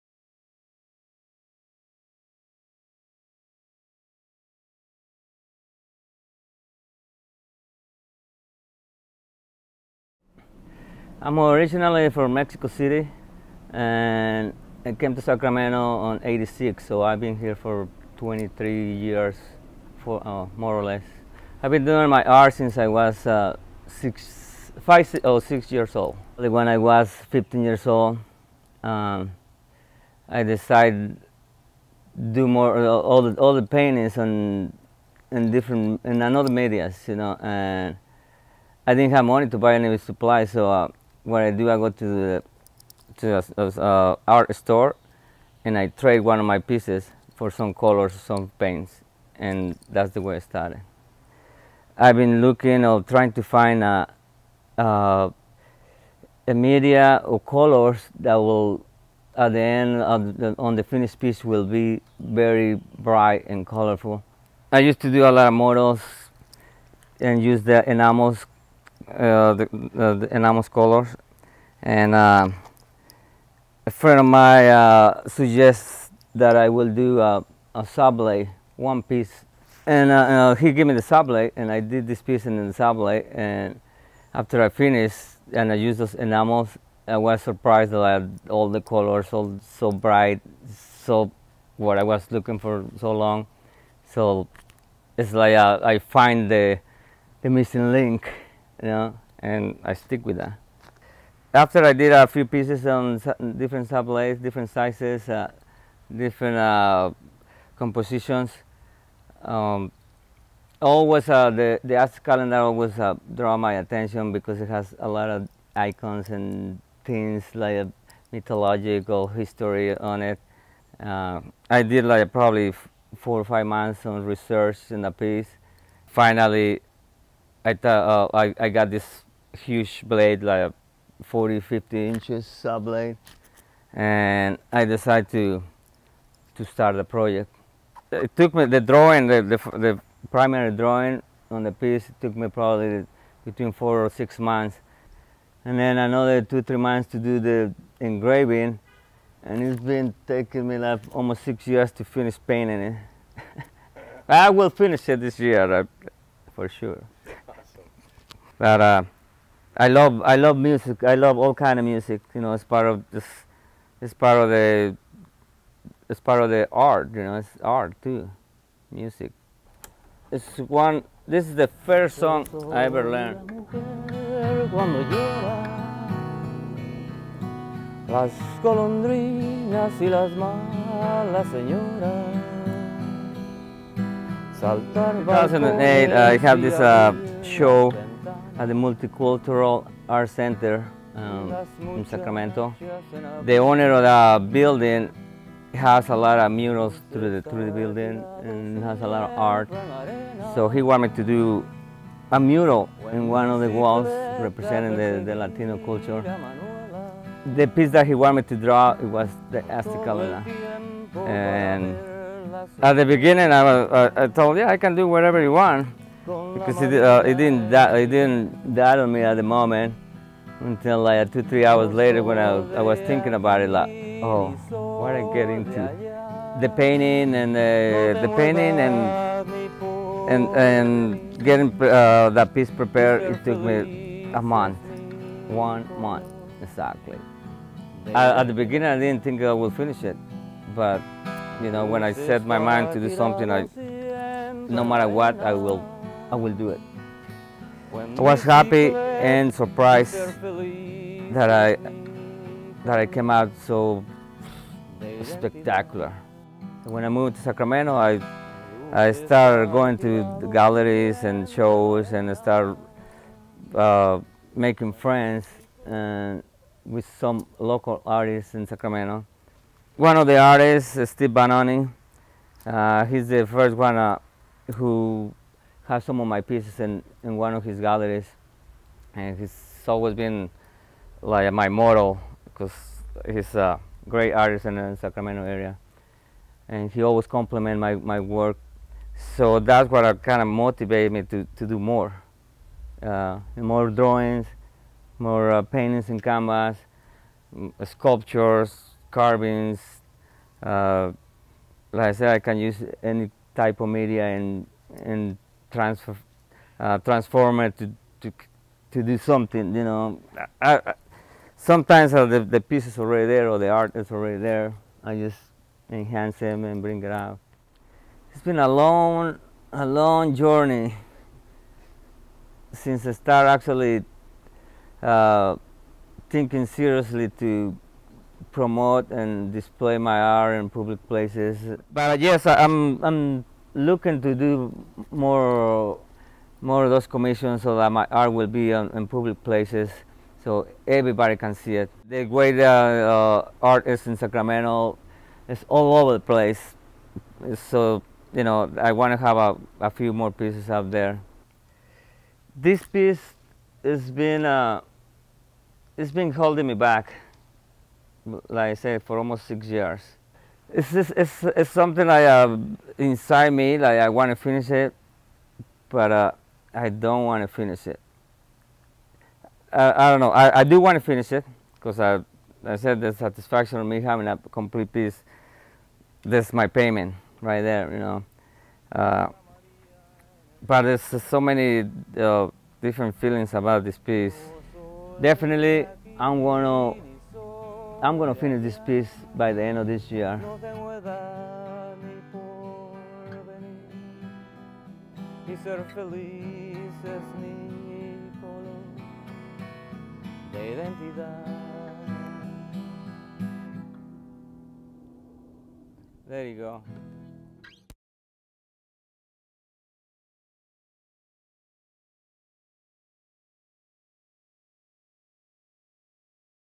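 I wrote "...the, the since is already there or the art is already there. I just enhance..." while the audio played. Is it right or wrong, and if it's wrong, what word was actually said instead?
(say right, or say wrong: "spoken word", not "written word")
wrong: "piece", not "since".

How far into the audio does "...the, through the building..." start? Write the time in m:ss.
3:17.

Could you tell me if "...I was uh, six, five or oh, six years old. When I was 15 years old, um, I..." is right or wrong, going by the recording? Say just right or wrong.
right.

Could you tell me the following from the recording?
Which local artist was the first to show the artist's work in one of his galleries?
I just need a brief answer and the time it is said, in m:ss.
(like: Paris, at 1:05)
Steve Banoni, at 4:31.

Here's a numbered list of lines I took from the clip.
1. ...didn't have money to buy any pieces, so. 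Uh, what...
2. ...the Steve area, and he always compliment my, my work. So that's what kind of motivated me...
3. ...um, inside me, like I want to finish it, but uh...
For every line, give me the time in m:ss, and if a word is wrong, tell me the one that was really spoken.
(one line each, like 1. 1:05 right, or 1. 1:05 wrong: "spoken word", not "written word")
1. 0:38 wrong: "supplies", not "pieces"
2. 4:44 wrong: "Sacramento", not "Steve"
3. 6:02 right.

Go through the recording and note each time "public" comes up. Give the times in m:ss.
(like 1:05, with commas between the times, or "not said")
5:30, 5:39.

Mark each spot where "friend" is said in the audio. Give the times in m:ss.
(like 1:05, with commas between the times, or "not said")
1:13, 4:24.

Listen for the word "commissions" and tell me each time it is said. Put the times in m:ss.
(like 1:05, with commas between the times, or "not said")
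5:37.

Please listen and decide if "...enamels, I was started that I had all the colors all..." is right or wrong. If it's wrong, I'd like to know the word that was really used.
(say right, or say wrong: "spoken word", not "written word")
wrong: "surprised", not "started".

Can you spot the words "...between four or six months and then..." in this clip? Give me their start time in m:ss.
2:23.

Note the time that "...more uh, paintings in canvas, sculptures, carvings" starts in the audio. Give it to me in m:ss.
4:55.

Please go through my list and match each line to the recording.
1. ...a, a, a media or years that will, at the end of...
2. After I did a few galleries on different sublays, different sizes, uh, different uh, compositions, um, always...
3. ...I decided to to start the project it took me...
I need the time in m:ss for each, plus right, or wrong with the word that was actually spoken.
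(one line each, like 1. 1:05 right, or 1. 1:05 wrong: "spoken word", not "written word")
1. 0:53 wrong: "colors", not "years"
2. 1:41 wrong: "pieces", not "galleries"
3. 2:14 right.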